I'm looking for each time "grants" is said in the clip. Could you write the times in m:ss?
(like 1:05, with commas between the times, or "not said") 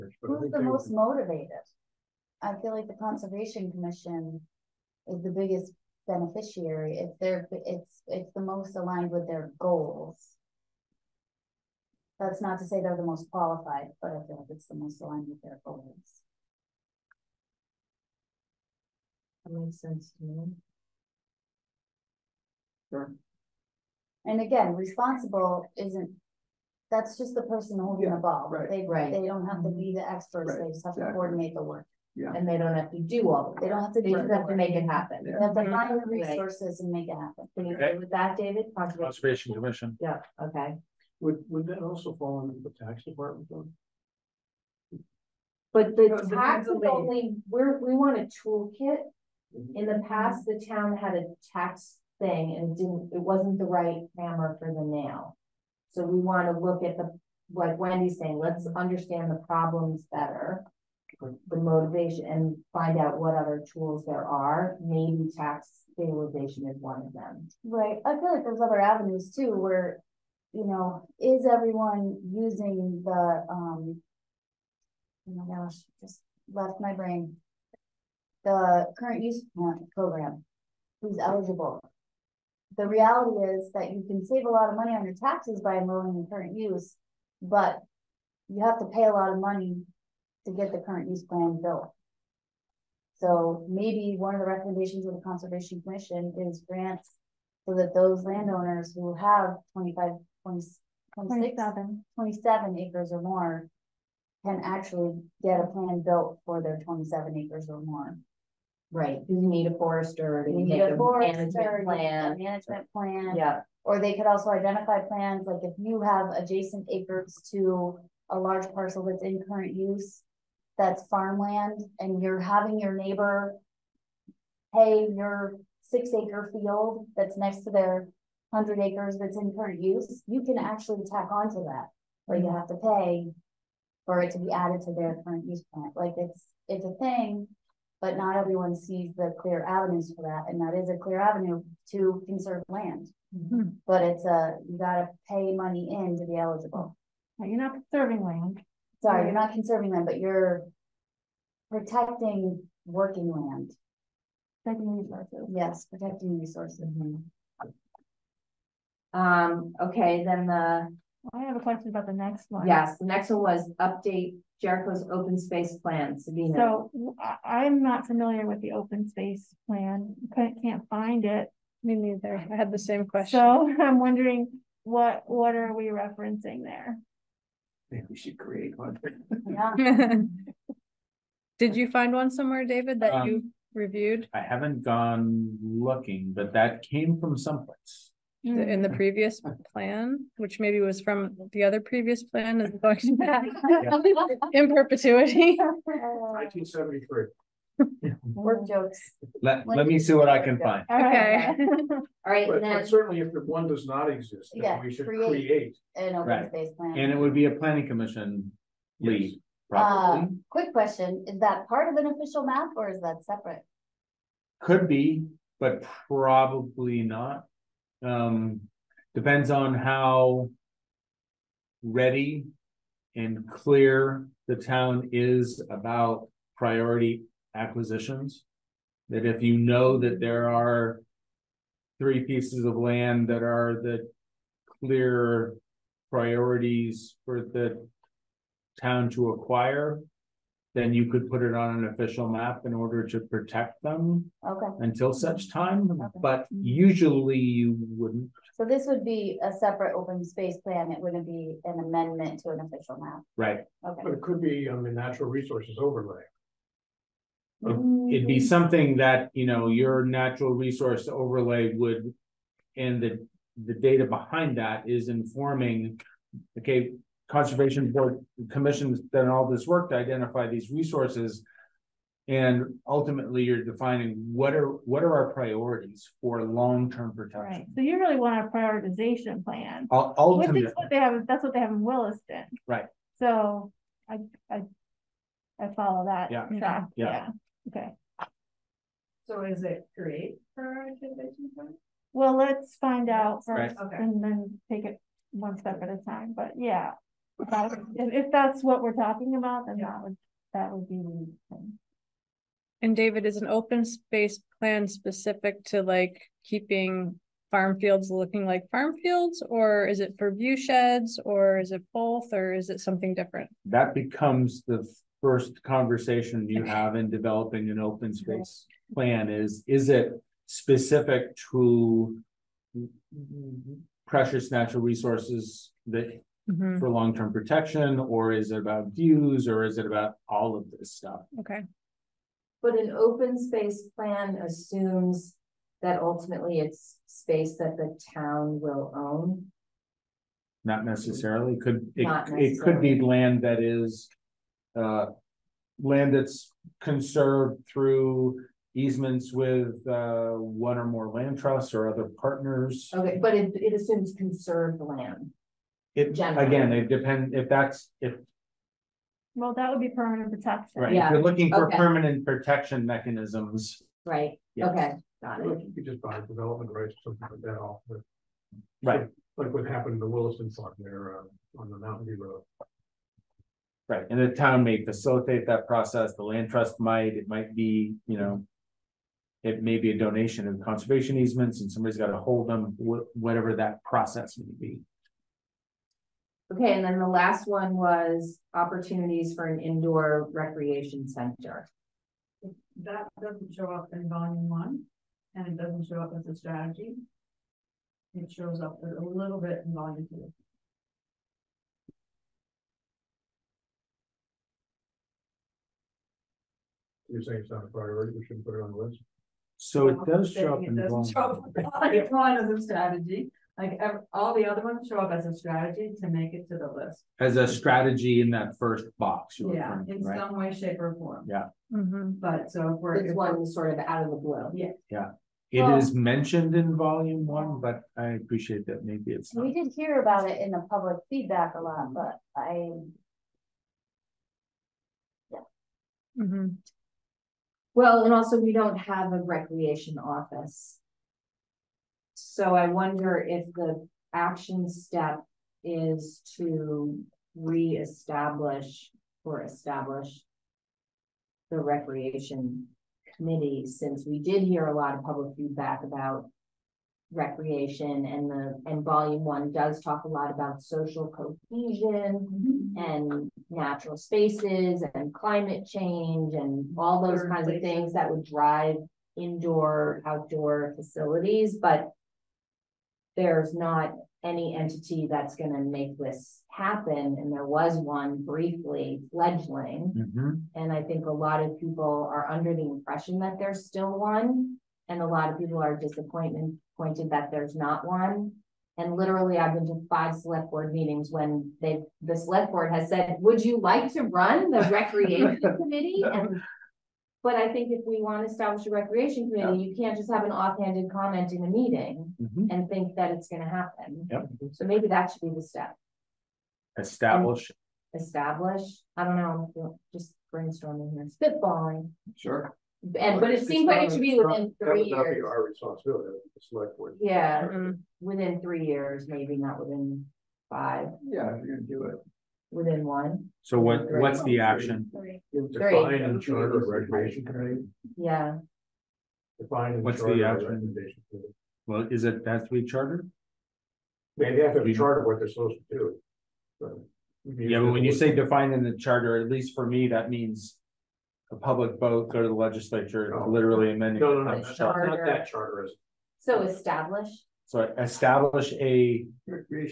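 1:36.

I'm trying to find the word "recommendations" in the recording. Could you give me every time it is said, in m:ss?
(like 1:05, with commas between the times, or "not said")
1:34, 8:50.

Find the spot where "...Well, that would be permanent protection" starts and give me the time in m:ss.
5:59.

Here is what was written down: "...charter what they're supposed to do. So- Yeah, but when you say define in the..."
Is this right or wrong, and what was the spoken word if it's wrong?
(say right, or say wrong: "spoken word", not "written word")
right.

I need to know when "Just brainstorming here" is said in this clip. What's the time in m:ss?
8:29.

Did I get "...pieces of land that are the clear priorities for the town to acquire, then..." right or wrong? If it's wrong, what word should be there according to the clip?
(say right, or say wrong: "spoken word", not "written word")
right.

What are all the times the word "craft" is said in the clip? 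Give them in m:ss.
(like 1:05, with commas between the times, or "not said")
not said.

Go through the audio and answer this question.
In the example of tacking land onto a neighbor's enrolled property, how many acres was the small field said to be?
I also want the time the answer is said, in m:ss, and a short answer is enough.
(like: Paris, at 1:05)
6, at 2:05.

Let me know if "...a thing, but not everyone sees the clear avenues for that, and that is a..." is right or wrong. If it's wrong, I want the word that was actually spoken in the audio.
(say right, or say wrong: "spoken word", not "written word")
right.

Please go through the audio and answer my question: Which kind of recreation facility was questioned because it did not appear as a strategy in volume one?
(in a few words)
indoor recreation center.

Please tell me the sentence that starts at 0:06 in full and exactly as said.
It's their it's it's the most aligned with their goals.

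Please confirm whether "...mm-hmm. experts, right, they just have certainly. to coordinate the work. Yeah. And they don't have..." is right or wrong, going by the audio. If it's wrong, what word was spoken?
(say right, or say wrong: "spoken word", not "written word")
wrong: "exactly", not "certainly".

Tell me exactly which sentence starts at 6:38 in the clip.
It shows up a little bit in volume two.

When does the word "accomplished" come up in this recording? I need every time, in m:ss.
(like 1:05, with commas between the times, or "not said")
not said.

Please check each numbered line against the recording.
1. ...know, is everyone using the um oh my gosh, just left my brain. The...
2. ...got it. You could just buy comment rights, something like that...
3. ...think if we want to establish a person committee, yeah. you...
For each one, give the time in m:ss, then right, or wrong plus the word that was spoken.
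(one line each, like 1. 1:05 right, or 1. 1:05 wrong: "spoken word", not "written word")
1. 1:10 right
2. 6:05 wrong: "development", not "comment"
3. 8:17 wrong: "recreation", not "person".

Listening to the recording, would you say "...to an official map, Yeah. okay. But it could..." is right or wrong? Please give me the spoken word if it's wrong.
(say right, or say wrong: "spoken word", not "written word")
wrong: "Right", not "Yeah".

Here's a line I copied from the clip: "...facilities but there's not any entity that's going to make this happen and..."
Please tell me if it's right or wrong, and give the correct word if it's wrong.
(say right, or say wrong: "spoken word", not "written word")
right.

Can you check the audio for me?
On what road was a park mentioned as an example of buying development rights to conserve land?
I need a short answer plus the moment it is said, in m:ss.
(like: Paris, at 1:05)
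Mountain View Road, at 6:11.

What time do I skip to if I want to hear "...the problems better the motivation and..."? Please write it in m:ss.
0:59.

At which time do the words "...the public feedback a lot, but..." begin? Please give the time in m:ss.
7:10.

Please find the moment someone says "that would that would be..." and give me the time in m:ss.
4:59.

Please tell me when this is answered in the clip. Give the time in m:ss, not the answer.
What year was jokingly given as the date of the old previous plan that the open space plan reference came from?
3:15.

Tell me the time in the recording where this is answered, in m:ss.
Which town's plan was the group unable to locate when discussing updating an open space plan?
2:44.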